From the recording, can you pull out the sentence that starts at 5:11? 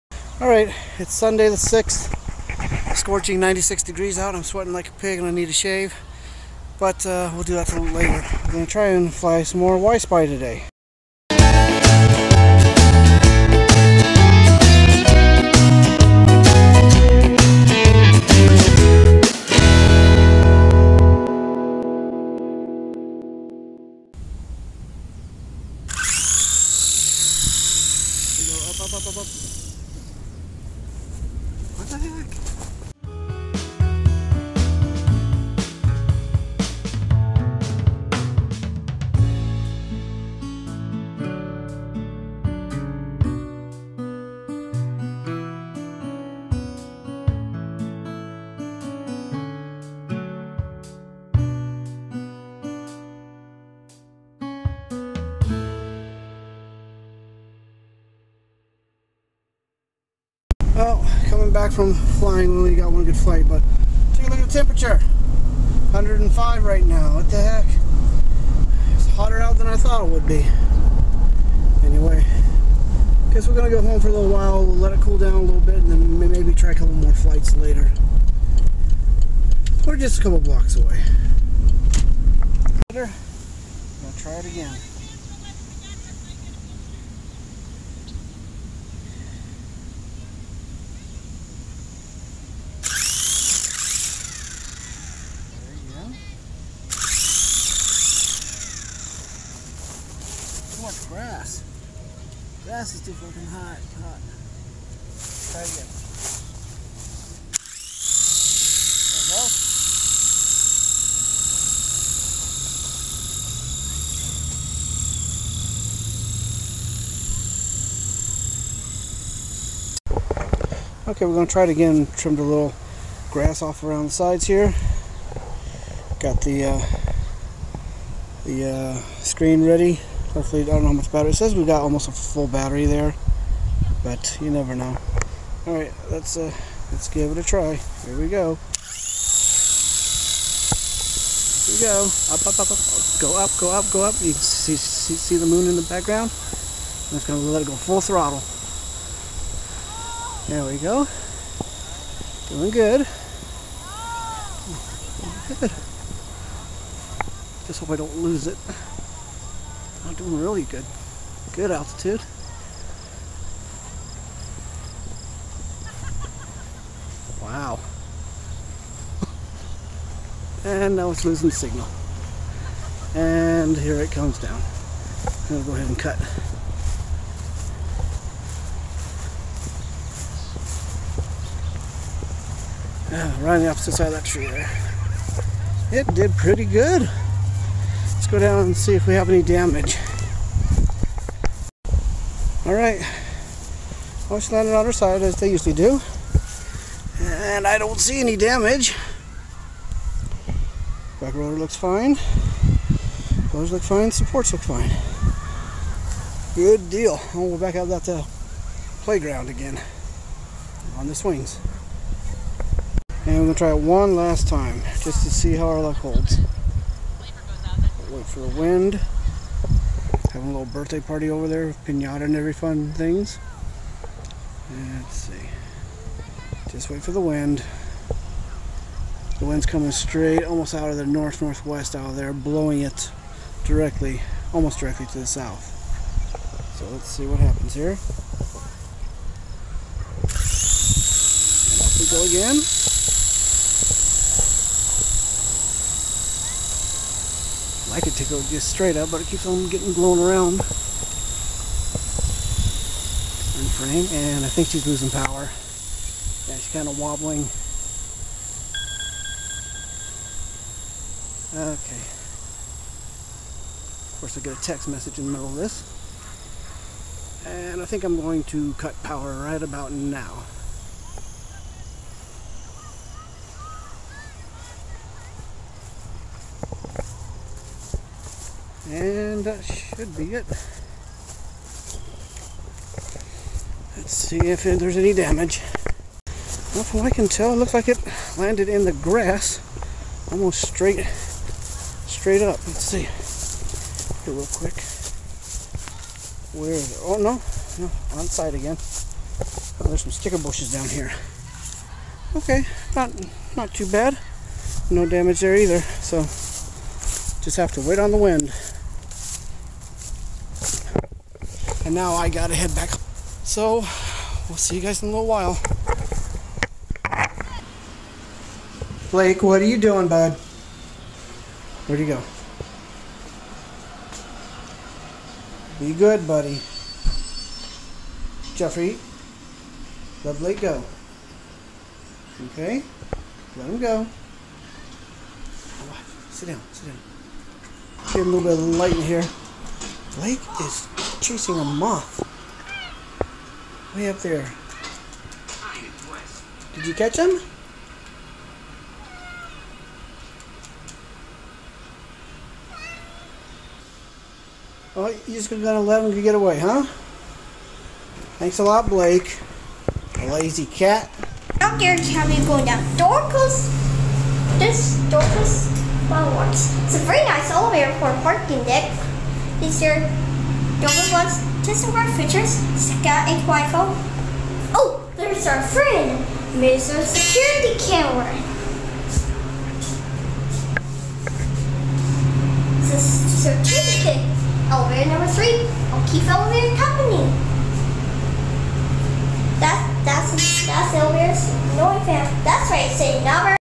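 And now I gotta head back.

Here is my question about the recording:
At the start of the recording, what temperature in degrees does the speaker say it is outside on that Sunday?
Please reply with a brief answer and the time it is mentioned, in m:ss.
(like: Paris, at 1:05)
96, at 0:03.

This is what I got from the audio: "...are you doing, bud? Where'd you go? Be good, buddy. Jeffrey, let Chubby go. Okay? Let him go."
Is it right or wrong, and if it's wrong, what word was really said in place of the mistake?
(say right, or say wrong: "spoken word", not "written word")
wrong: "Blake", not "Chubby".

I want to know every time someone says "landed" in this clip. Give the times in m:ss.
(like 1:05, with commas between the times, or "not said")
3:14, 4:48.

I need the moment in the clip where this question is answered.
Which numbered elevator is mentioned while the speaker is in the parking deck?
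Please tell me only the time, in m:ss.
6:24.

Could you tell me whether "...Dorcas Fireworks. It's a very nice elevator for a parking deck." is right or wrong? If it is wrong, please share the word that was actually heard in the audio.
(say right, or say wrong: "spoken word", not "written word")
right.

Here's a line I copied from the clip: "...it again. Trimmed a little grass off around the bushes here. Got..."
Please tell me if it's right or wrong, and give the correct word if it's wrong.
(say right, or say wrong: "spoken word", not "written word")
wrong: "sides", not "bushes".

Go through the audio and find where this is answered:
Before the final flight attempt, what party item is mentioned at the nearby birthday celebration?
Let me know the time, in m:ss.
3:41.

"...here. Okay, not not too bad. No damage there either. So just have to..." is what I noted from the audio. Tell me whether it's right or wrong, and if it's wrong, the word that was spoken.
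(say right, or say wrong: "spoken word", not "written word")
right.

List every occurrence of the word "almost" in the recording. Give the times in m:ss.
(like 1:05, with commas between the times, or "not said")
2:11, 3:50, 3:54, 4:50.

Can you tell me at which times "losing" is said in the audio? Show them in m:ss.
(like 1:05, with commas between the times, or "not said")
2:51, 4:14.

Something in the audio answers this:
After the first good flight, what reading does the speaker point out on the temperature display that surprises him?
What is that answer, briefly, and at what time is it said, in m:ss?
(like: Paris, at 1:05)
105, at 1:05.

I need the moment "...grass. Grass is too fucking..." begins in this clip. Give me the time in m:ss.
1:41.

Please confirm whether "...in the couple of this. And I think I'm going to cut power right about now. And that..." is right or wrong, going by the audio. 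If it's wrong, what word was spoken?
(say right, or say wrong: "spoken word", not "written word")
wrong: "middle", not "couple".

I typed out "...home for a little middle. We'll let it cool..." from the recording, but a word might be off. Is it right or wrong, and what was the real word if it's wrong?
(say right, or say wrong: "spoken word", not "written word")
wrong: "while", not "middle".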